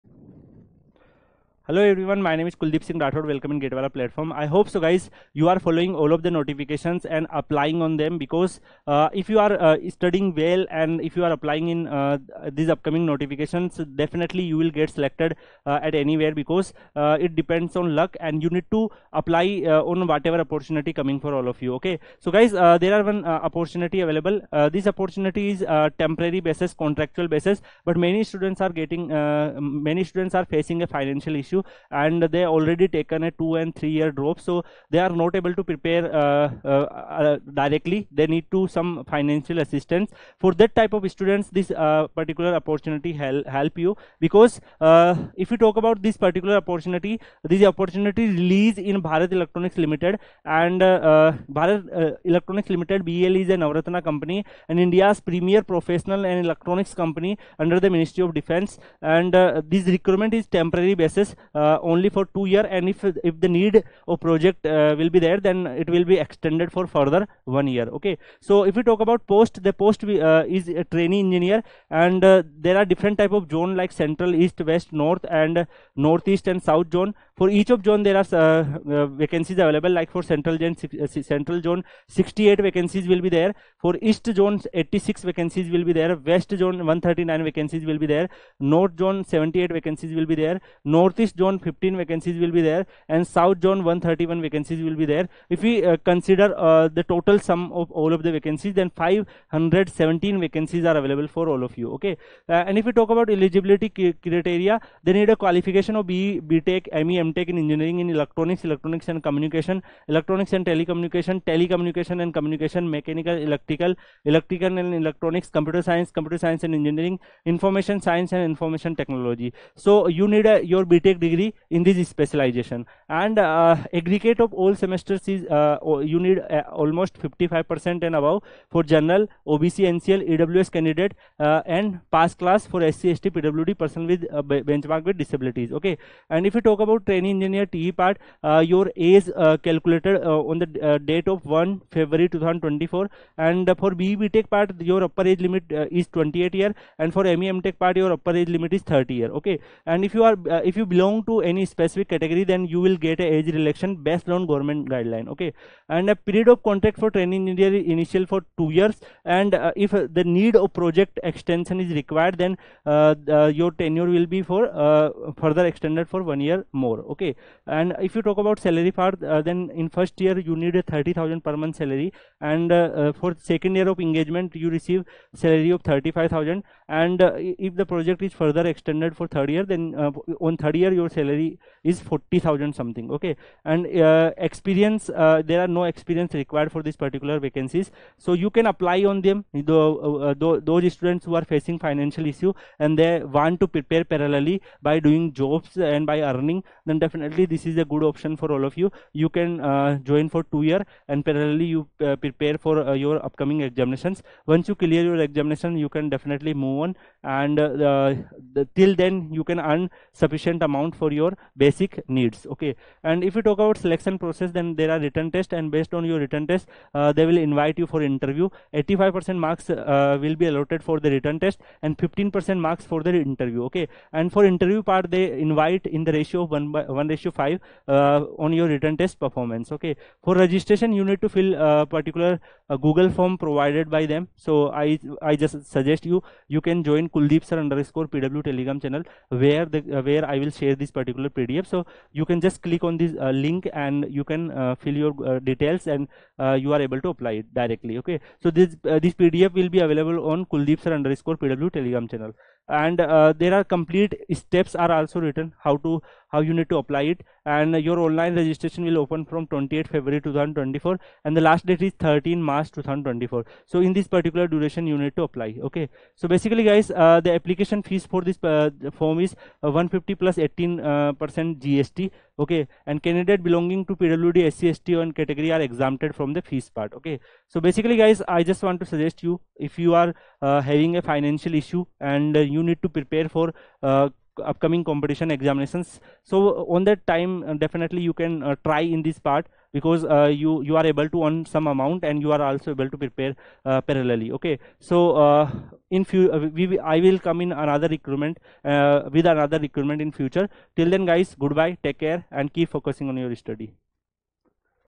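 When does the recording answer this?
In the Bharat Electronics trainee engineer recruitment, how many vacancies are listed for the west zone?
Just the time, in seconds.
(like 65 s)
86 s.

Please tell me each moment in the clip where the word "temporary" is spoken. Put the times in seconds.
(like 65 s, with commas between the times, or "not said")
26 s, 60 s.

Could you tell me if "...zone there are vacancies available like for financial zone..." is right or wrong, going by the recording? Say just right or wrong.
wrong.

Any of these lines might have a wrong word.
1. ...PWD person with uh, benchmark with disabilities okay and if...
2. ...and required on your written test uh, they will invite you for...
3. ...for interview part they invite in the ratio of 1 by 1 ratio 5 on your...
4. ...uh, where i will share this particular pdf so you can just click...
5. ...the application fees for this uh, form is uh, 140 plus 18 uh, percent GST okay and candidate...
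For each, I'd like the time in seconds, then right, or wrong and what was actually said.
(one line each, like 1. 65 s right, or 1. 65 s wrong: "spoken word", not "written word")
1. 133 s right
2. 215 s wrong: "based", not "required"
3. 224 s right
4. 239 s right
5. 267 s wrong: "150", not "140".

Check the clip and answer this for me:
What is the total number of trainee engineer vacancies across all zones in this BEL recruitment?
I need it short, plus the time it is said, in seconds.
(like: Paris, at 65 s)
517, at 98 s.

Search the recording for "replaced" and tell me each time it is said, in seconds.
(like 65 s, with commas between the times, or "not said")
not said.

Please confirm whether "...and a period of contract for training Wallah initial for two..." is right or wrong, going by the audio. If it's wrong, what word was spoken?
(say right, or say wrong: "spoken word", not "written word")
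wrong: "India", not "Wallah".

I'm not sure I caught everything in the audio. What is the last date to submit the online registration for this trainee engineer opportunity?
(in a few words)
13 March 2024.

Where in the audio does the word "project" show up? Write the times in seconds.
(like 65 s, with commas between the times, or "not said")
64 s, 160 s, 177 s.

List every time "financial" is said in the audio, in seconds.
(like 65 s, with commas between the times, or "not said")
30 s, 39 s, 191 s, 281 s.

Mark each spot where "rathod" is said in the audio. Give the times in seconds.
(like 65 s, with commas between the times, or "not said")
3 s.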